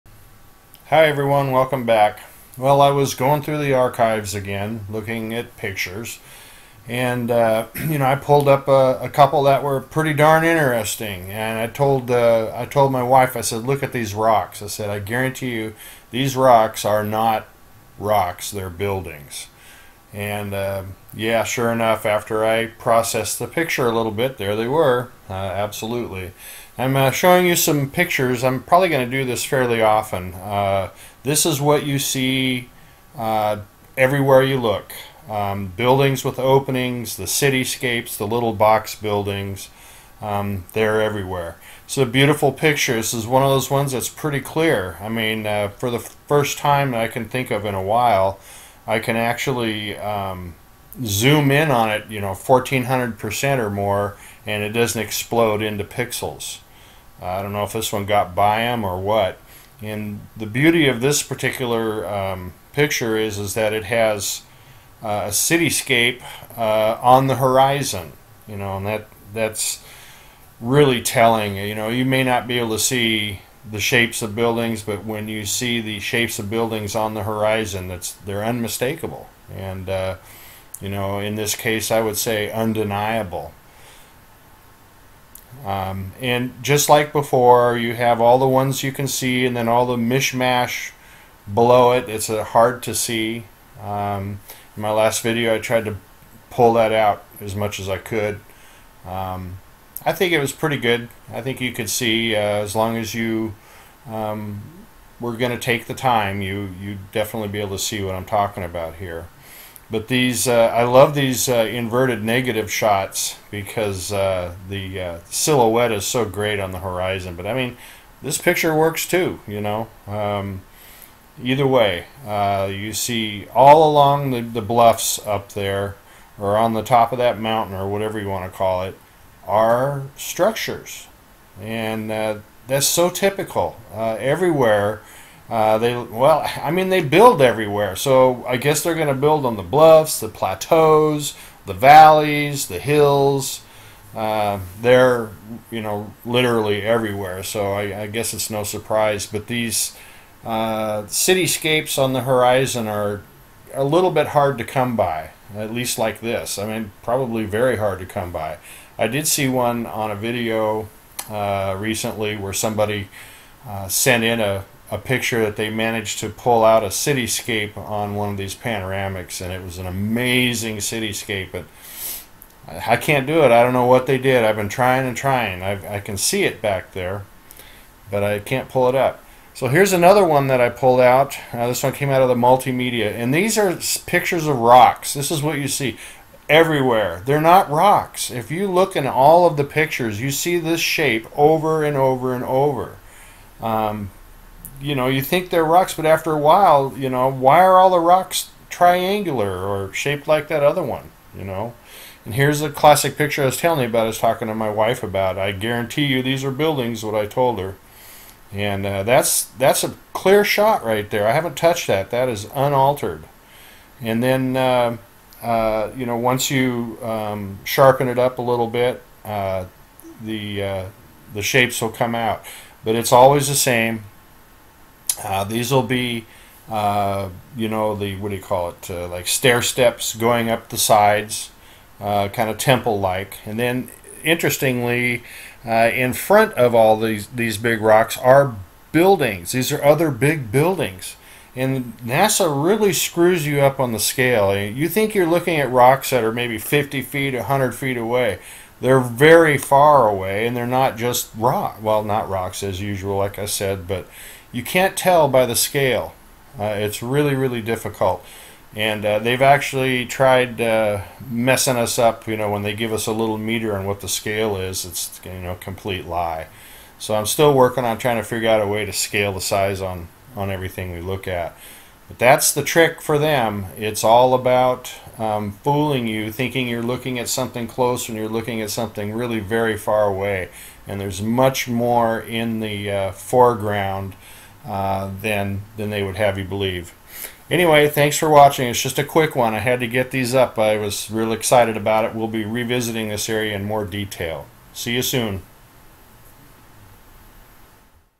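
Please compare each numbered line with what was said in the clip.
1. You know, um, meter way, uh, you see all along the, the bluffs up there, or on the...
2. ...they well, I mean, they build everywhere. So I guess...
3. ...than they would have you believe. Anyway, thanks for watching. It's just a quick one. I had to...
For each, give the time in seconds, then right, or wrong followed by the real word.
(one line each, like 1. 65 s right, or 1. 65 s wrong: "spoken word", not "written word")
1. 119 s wrong: "either", not "meter"
2. 135 s right
3. 285 s right.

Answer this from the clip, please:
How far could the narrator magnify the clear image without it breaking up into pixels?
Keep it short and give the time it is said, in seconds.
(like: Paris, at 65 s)
1400%, at 52 s.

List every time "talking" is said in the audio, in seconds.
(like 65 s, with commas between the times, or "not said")
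108 s, 204 s.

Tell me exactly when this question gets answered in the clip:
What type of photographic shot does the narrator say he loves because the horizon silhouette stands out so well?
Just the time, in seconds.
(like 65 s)
111 s.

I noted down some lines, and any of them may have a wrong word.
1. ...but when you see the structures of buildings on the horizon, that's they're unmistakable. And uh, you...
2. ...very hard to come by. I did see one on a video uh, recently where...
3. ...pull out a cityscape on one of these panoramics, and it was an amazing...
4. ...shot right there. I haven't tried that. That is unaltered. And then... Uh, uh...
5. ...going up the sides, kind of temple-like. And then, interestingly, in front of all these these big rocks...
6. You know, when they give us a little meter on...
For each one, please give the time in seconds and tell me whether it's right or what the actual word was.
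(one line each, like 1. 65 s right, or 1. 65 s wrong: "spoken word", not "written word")
1. 74 s wrong: "shapes", not "structures"
2. 157 s right
3. 166 s right
4. 210 s wrong: "touched", not "tried"
5. 230 s right
6. 262 s right.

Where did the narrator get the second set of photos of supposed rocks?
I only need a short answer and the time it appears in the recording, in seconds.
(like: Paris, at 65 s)
The multimedia, at 182 s.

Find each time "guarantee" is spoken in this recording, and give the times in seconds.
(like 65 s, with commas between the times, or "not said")
14 s, 205 s.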